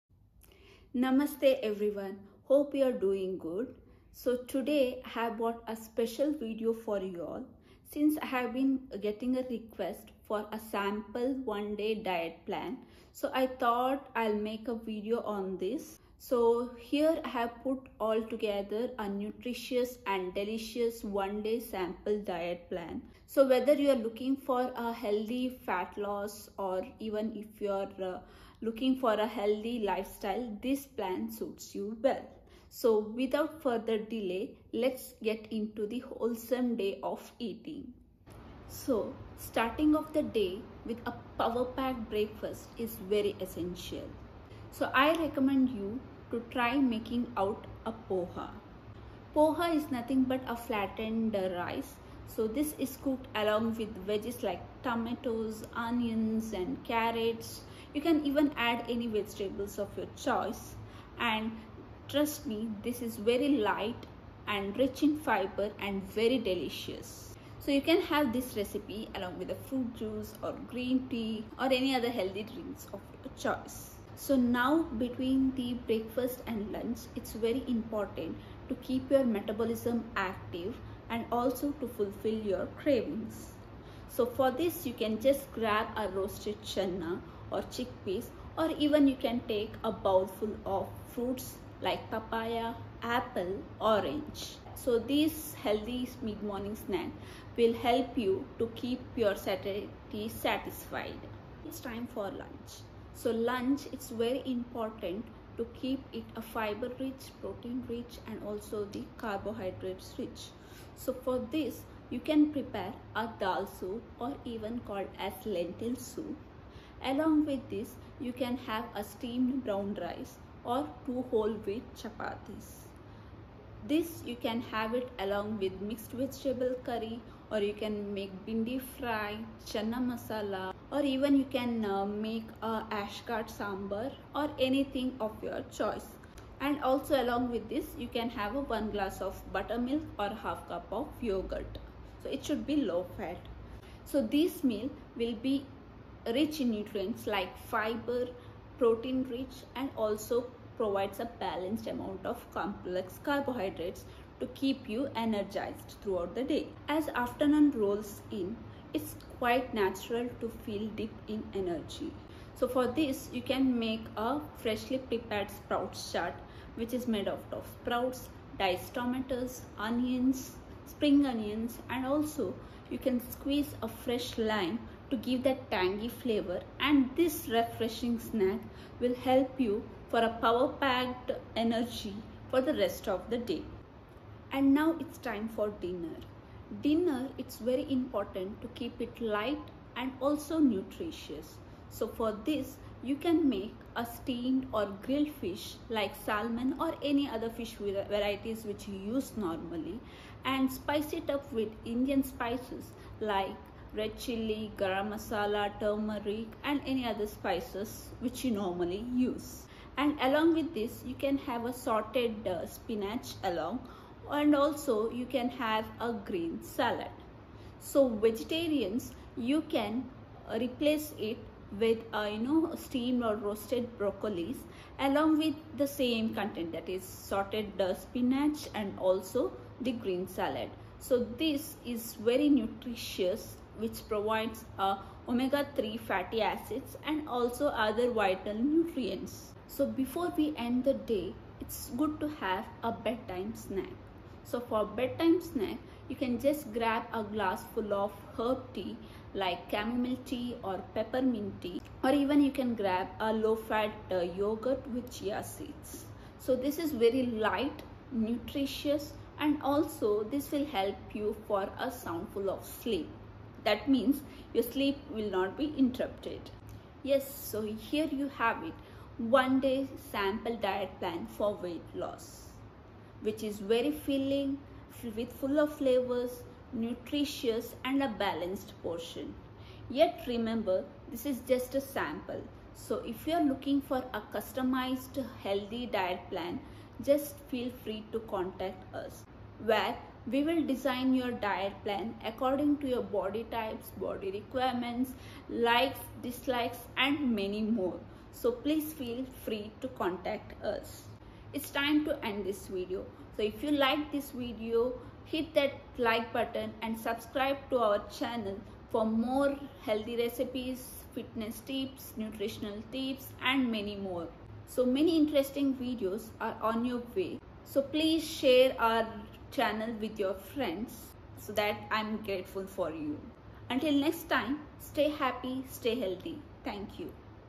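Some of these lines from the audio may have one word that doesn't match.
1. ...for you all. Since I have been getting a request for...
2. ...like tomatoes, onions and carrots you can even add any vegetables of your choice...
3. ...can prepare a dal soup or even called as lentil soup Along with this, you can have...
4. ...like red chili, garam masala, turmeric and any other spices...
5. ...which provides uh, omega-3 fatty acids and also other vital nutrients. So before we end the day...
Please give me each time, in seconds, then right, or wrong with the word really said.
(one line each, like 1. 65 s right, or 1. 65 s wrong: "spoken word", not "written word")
1. 6 s right
2. 54 s right
3. 112 s right
4. 203 s right
5. 233 s right.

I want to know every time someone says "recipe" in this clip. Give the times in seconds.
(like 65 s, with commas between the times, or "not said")
68 s, 310 s.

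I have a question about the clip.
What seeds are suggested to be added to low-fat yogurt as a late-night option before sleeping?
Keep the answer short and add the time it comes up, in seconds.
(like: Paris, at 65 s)
Chia seeds, at 255 s.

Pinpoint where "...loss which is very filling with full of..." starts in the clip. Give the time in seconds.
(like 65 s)
272 s.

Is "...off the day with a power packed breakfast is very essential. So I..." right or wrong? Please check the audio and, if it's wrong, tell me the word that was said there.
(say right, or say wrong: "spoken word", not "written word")
right.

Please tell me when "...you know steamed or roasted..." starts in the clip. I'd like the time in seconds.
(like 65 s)
222 s.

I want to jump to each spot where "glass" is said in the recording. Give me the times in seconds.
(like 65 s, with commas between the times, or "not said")
138 s, 247 s.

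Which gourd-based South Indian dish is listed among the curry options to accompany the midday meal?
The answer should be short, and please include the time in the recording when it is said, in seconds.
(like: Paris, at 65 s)
Ash gourd sambar, at 132 s.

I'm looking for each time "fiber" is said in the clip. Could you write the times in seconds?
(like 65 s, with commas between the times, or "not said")
65 s, 106 s, 147 s.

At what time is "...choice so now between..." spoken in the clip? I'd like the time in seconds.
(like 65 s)
73 s.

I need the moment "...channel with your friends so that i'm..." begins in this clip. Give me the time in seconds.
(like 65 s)
319 s.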